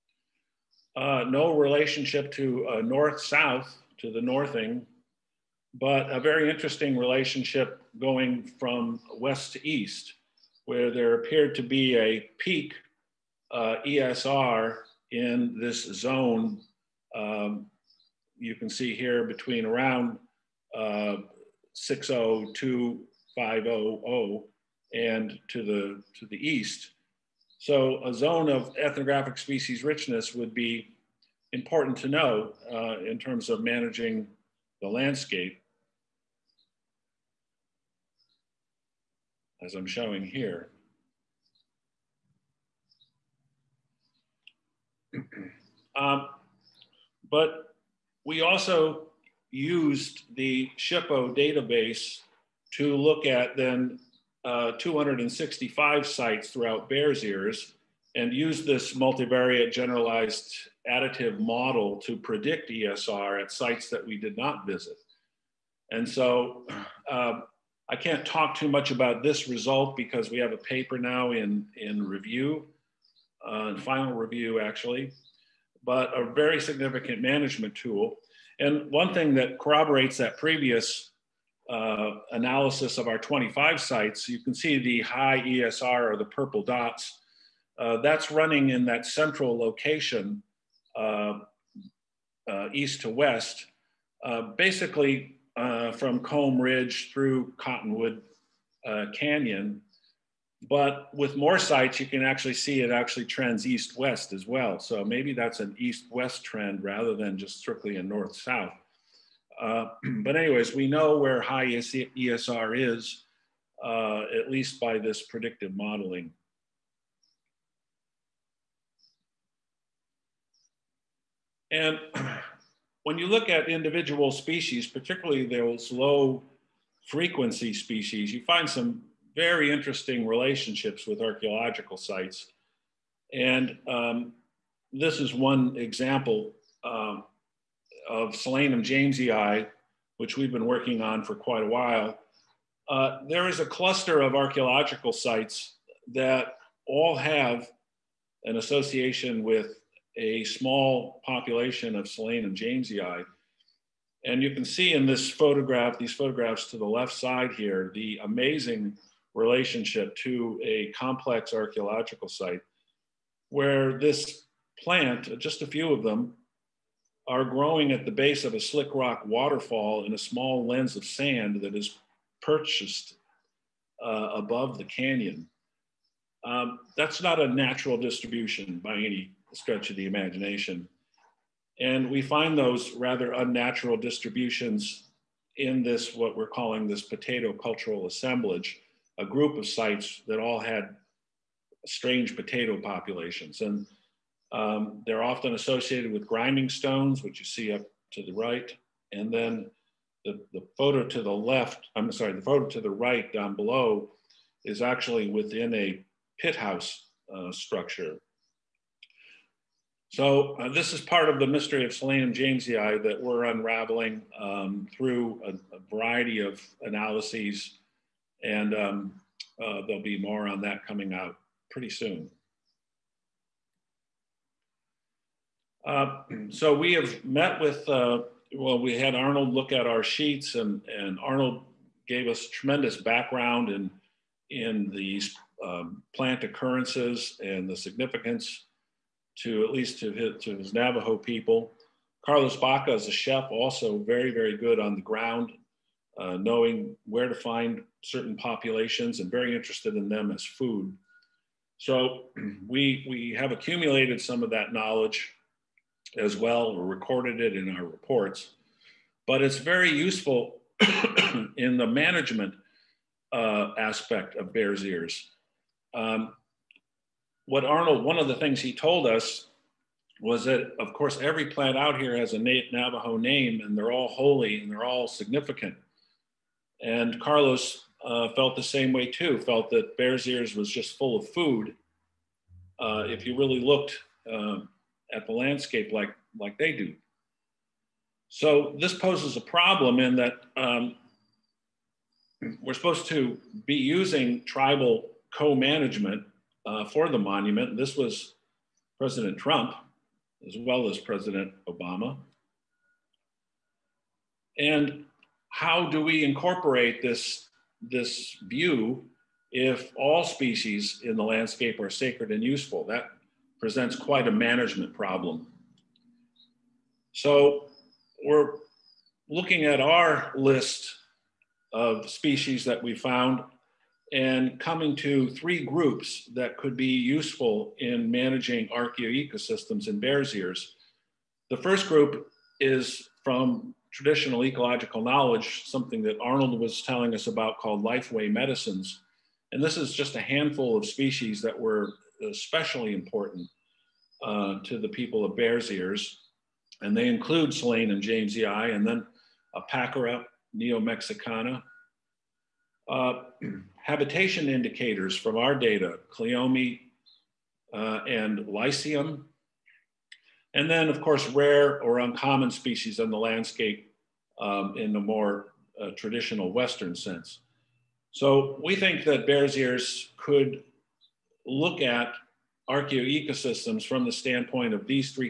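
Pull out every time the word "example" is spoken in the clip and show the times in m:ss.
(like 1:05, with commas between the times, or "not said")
2:15.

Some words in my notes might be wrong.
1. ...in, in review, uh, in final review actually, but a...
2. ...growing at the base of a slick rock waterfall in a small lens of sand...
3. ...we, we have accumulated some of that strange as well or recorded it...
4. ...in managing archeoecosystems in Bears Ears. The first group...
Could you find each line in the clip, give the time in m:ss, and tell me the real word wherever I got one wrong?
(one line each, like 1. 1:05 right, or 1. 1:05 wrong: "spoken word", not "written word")
1. 1:11 right
2. 2:47 right
3. 4:12 wrong: "knowledge", not "strange"
4. 5:27 right.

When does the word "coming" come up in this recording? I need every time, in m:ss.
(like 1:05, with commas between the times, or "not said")
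3:40, 5:24.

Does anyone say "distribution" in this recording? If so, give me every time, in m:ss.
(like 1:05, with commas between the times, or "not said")
2:57, 3:03.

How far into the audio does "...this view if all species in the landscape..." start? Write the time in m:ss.
5:07.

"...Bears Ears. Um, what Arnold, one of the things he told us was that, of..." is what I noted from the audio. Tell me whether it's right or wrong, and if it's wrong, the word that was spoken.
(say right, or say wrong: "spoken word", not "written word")
right.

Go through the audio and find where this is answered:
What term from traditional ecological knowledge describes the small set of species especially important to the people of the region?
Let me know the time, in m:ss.
5:37.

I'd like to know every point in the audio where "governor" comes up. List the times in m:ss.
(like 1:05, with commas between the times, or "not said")
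not said.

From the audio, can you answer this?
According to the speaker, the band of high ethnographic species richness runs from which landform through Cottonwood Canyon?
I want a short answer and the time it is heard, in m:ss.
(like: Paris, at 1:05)
Comb Ridge, at 1:36.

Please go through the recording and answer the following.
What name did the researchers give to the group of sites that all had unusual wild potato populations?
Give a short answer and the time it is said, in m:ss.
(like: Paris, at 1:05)
potato cultural assemblage, at 3:07.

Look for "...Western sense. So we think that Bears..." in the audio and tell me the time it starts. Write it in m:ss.
6:06.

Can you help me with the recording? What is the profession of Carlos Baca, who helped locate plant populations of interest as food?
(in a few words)
chef.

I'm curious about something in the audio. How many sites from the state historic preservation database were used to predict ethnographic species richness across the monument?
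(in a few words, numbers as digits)
265.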